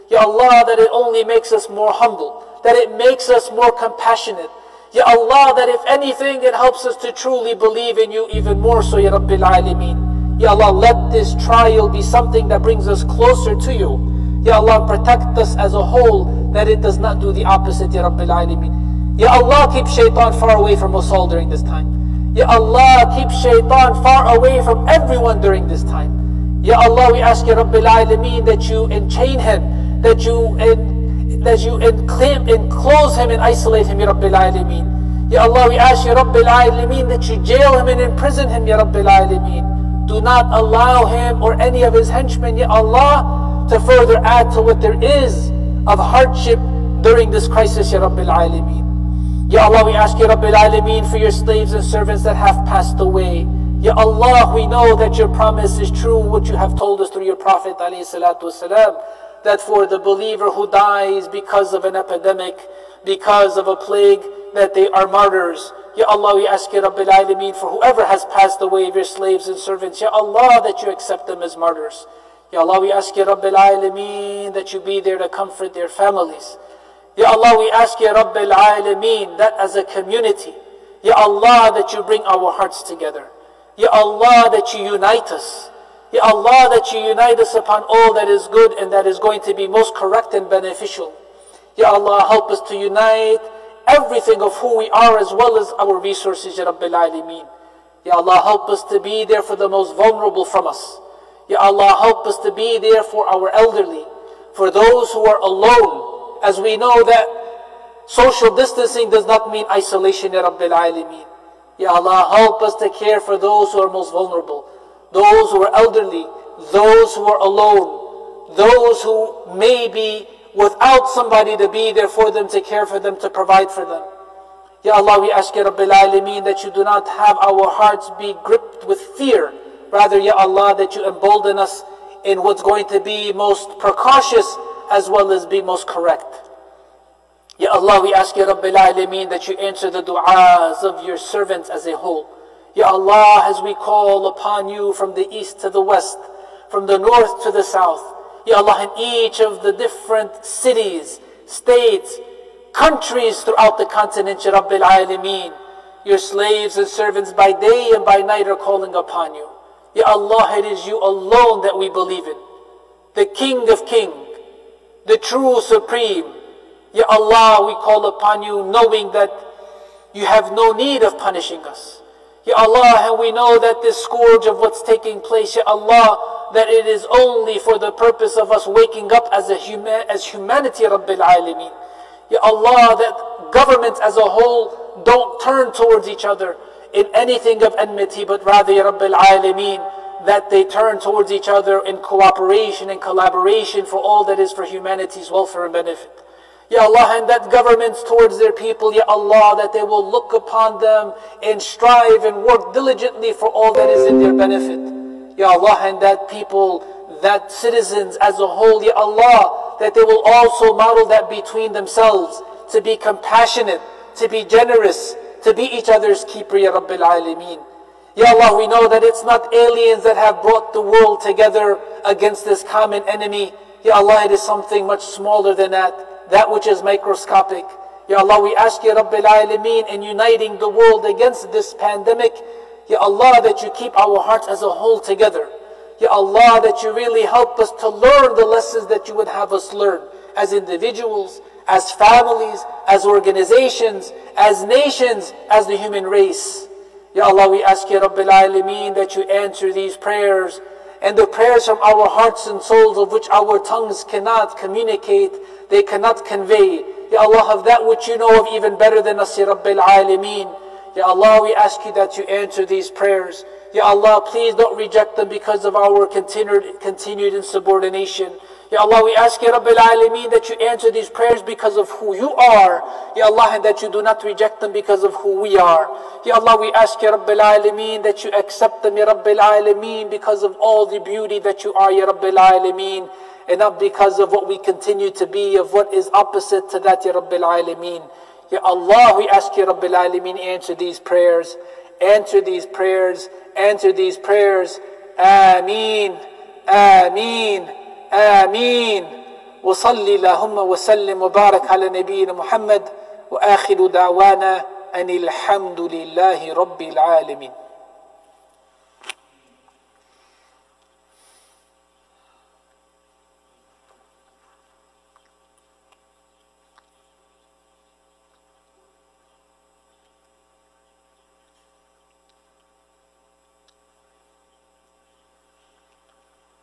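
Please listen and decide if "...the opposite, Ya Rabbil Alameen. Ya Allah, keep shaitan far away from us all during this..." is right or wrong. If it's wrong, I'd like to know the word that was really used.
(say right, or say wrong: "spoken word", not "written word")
right.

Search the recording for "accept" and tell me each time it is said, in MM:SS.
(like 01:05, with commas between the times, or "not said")
01:10, 04:38.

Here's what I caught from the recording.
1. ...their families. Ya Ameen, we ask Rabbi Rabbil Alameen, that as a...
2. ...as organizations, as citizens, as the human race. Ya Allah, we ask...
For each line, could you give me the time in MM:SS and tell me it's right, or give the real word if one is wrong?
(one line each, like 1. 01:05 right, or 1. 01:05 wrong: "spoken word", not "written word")
1. 01:15 wrong: "Allah", not "Ameen"
2. 04:02 wrong: "nations", not "citizens".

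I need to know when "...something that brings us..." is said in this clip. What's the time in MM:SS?
00:12.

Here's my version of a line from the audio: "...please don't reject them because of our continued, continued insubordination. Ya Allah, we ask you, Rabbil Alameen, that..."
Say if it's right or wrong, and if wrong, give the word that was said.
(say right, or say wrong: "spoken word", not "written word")
right.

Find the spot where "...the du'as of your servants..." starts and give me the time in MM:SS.
02:19.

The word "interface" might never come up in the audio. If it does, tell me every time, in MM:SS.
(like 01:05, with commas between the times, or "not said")
not said.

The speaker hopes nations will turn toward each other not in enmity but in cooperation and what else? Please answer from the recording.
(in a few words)
collaboration.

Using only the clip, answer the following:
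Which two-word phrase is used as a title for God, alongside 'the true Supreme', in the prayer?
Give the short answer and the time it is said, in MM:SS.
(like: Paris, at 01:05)
King of Kings, at 02:43.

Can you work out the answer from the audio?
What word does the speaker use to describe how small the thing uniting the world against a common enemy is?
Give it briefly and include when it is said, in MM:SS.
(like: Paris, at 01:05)
microscopic, at 03:46.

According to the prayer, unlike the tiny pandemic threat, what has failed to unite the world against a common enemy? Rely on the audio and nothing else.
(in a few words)
aliens.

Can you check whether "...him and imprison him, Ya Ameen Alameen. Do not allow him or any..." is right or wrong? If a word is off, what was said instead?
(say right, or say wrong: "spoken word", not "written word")
wrong: "Rabbil", not "Ameen".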